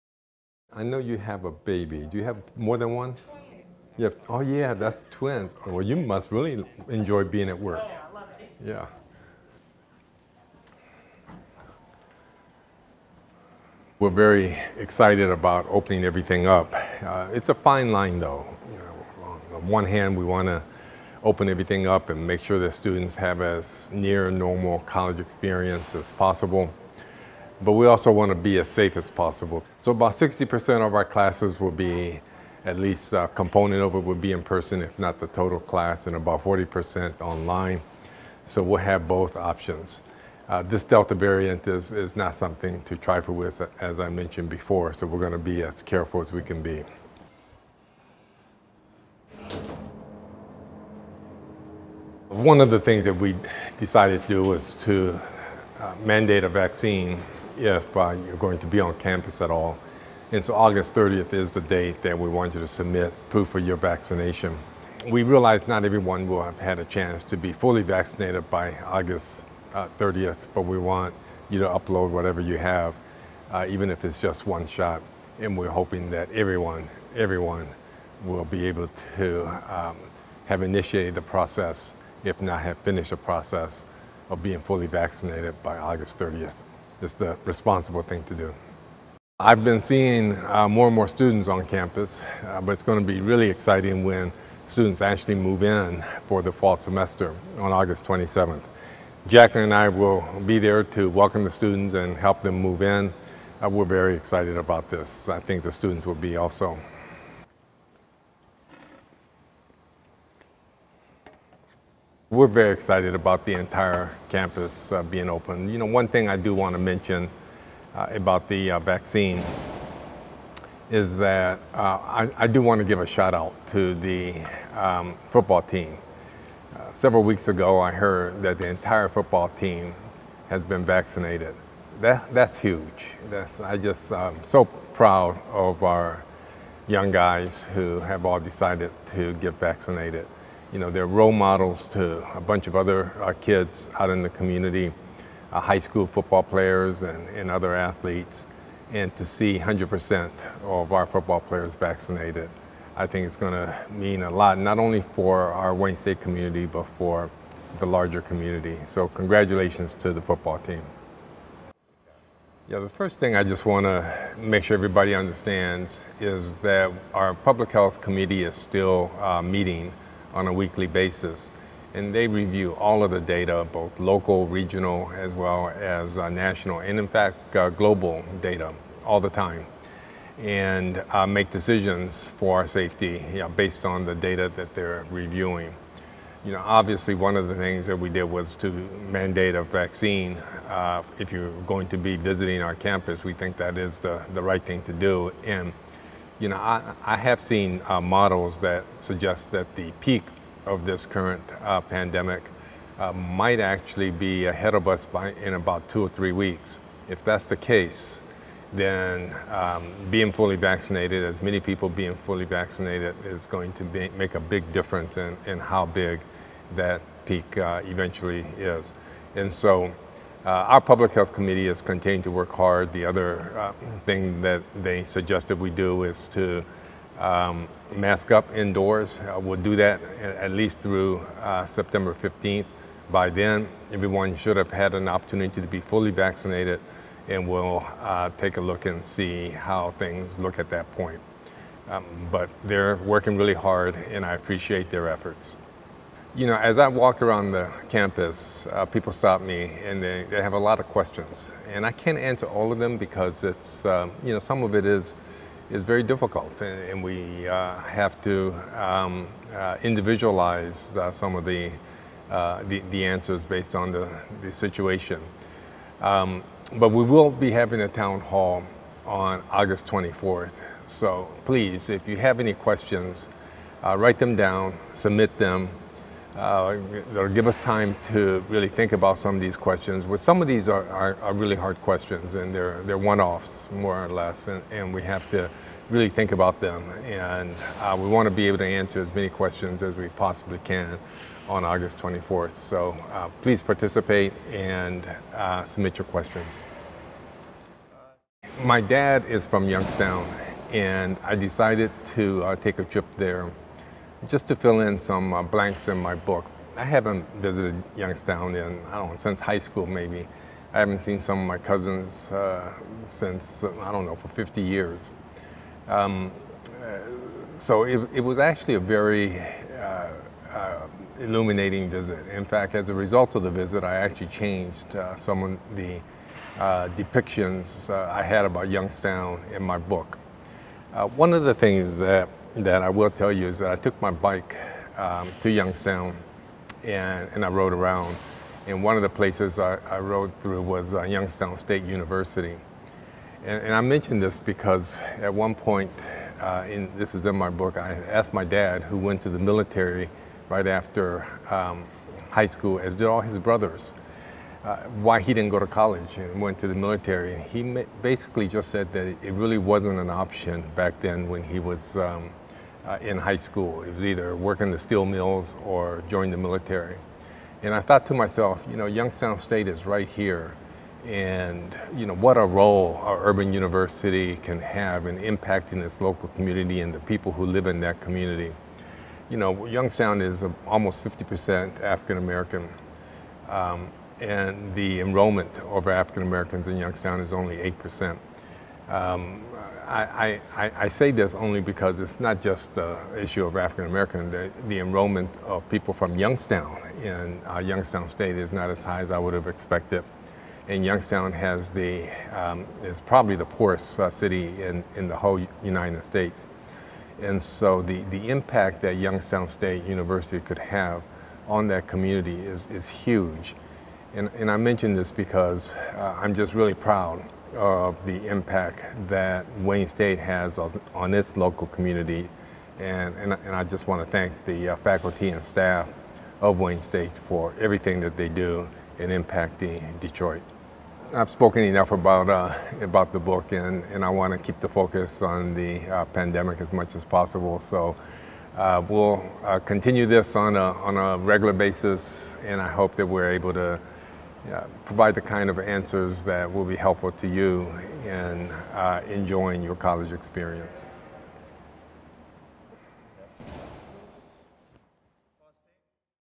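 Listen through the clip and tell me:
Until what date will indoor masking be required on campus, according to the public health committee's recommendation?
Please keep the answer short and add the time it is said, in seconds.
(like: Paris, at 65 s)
September 15th, at 231 s.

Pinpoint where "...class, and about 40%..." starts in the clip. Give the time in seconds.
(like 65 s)
35 s.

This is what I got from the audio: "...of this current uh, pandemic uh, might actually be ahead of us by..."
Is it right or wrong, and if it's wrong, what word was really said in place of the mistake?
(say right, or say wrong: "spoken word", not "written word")
right.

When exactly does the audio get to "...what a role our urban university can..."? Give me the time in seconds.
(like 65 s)
372 s.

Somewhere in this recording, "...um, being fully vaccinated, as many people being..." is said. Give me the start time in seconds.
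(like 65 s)
209 s.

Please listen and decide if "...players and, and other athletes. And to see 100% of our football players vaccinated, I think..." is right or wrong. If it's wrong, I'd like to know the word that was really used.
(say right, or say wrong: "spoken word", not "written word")
right.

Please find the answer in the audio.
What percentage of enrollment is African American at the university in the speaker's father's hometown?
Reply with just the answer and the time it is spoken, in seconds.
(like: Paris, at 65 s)
8%, at 387 s.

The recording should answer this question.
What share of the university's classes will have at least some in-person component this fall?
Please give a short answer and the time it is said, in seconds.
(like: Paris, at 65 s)
60%, at 30 s.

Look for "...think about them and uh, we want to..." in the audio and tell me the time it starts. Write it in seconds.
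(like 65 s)
286 s.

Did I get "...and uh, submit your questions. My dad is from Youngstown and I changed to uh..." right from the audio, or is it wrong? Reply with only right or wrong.
wrong.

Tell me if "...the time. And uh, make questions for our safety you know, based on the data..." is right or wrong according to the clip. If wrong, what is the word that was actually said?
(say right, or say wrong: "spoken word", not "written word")
wrong: "decisions", not "questions".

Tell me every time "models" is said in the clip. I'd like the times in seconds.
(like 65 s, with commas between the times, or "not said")
141 s, 198 s.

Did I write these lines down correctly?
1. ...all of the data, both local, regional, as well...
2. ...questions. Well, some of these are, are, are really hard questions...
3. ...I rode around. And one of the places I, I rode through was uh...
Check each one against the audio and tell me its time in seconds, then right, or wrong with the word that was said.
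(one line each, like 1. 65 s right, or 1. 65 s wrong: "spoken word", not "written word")
1. 172 s right
2. 279 s right
3. 337 s right.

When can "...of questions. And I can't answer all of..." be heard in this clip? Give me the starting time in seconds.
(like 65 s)
250 s.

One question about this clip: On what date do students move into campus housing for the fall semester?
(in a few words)
August 27th.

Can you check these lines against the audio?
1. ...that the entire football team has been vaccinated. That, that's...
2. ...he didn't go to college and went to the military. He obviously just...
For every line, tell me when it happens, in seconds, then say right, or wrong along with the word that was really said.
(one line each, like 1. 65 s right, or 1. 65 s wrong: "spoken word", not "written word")
1. 128 s right
2. 355 s wrong: "basically", not "obviously".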